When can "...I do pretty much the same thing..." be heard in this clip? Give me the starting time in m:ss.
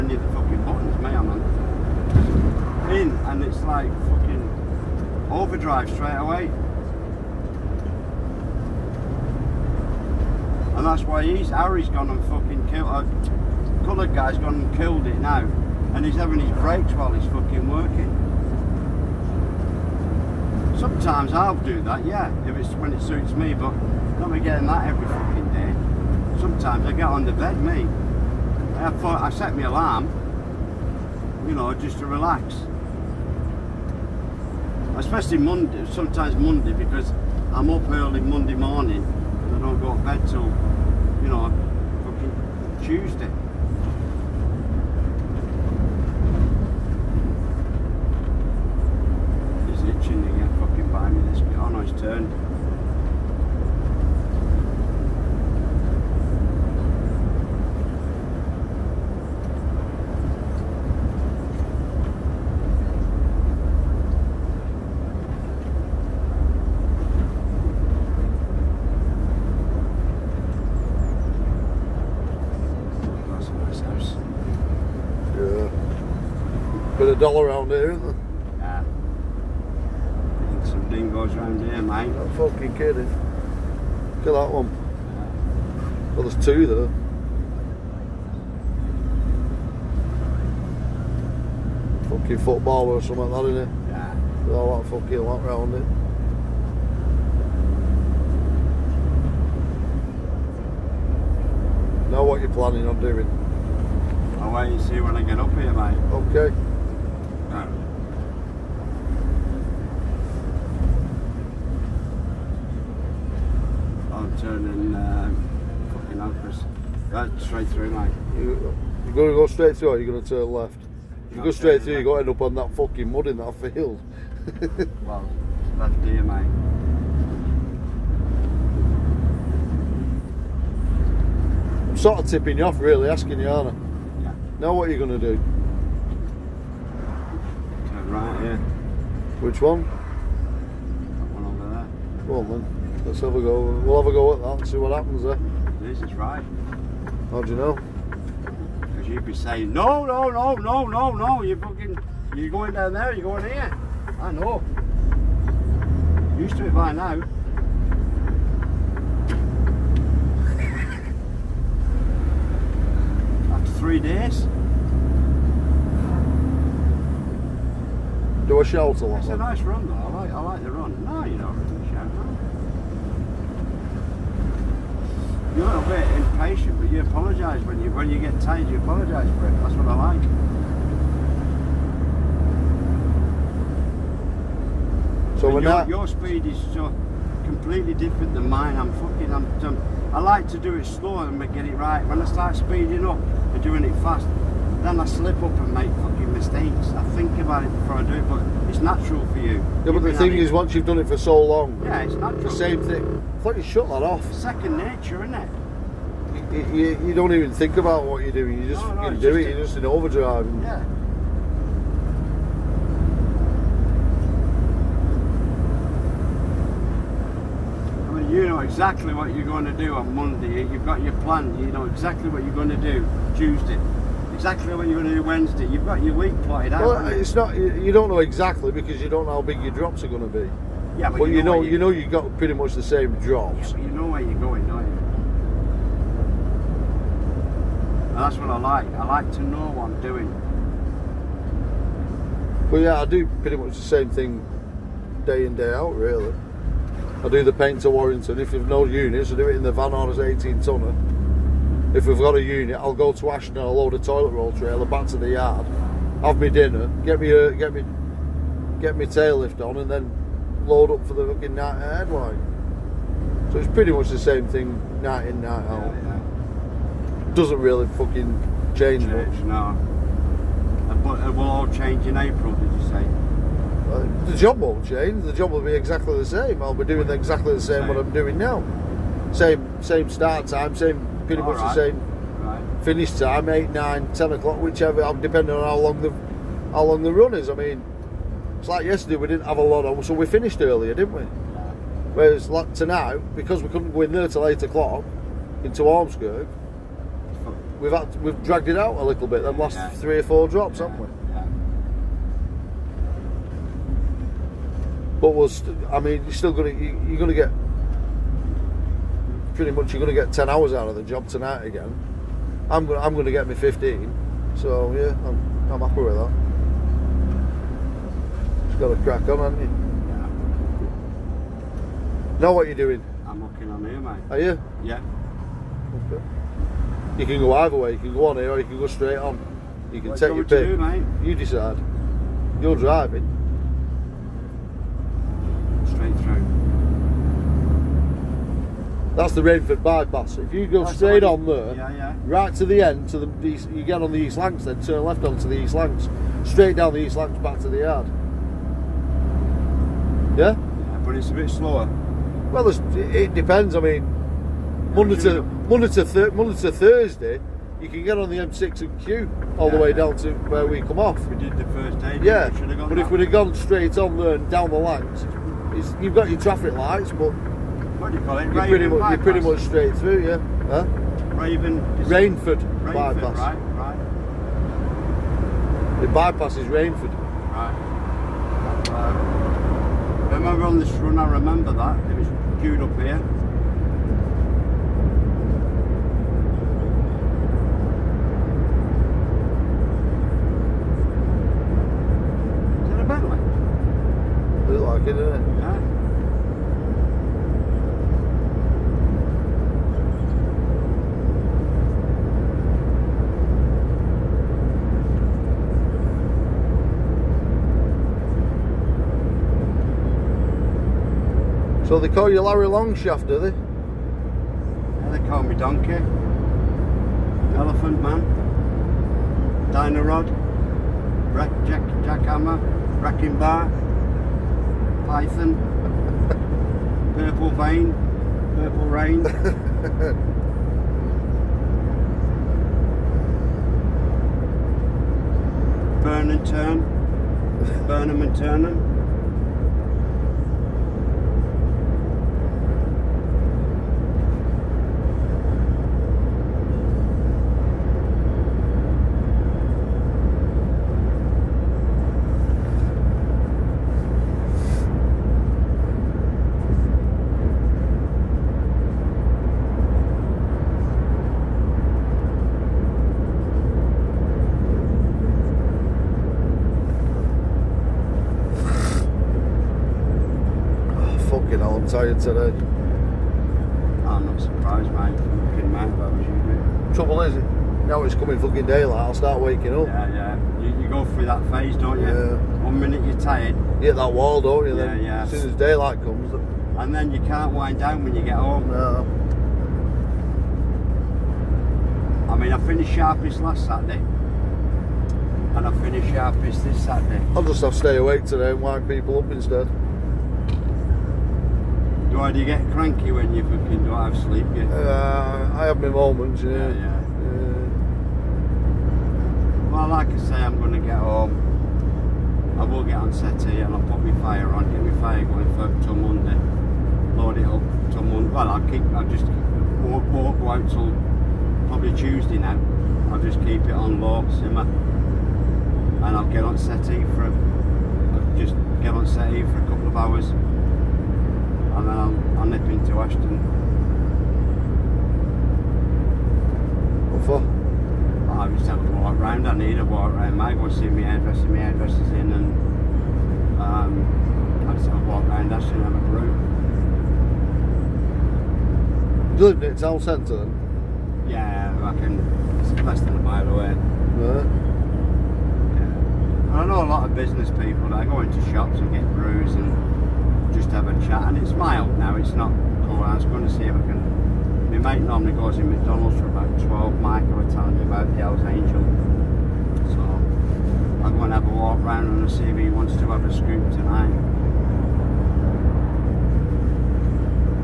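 4:02.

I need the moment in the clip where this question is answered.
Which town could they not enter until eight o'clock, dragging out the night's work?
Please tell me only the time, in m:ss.
4:55.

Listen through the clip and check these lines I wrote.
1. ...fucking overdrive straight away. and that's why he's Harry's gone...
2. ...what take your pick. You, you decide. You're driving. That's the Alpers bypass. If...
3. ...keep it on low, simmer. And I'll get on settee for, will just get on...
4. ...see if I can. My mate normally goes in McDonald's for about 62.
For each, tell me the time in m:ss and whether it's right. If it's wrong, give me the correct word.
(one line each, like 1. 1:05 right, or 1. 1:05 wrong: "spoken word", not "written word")
1. 0:04 right
2. 5:30 wrong: "Rainford", not "Alpers"
3. 8:43 right
4. 9:23 wrong: "12", not "62".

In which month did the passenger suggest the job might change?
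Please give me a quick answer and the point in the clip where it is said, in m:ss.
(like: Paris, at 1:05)
April, at 4:32.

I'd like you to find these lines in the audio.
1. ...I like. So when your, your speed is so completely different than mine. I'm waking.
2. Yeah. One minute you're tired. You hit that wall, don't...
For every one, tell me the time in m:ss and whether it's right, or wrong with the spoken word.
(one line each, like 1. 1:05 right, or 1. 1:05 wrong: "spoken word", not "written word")
1. 2:59 wrong: "fucking", not "waking"
2. 8:02 right.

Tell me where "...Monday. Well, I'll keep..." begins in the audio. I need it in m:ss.
8:38.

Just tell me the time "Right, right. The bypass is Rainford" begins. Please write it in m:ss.
6:13.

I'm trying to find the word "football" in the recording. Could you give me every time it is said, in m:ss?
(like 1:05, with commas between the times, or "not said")
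1:32.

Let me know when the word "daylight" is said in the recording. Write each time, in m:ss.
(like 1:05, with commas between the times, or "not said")
7:58, 8:05.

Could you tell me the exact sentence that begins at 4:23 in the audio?
So it's pretty much the same thing night in night out.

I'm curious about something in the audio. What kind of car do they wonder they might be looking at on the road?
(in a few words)
Bentley.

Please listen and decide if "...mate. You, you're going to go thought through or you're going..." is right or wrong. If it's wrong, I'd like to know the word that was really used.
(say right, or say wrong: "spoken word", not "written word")
wrong: "straight", not "thought".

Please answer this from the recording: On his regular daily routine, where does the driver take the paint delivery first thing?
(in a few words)
Warrington.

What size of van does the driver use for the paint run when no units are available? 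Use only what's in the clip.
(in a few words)
18 tonner.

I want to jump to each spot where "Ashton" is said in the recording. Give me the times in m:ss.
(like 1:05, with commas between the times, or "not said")
4:13, 8:52, 9:05.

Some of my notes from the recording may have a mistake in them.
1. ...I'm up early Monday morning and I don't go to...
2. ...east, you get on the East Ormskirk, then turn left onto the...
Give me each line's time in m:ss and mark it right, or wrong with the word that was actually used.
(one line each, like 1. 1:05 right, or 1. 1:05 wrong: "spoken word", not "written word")
1. 0:37 right
2. 5:43 wrong: "Lancs", not "Ormskirk".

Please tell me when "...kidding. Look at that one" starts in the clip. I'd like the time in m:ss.
1:22.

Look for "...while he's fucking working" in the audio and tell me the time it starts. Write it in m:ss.
0:16.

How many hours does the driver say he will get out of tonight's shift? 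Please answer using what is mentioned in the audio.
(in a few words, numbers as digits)
15.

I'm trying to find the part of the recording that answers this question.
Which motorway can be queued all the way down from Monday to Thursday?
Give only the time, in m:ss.
5:58.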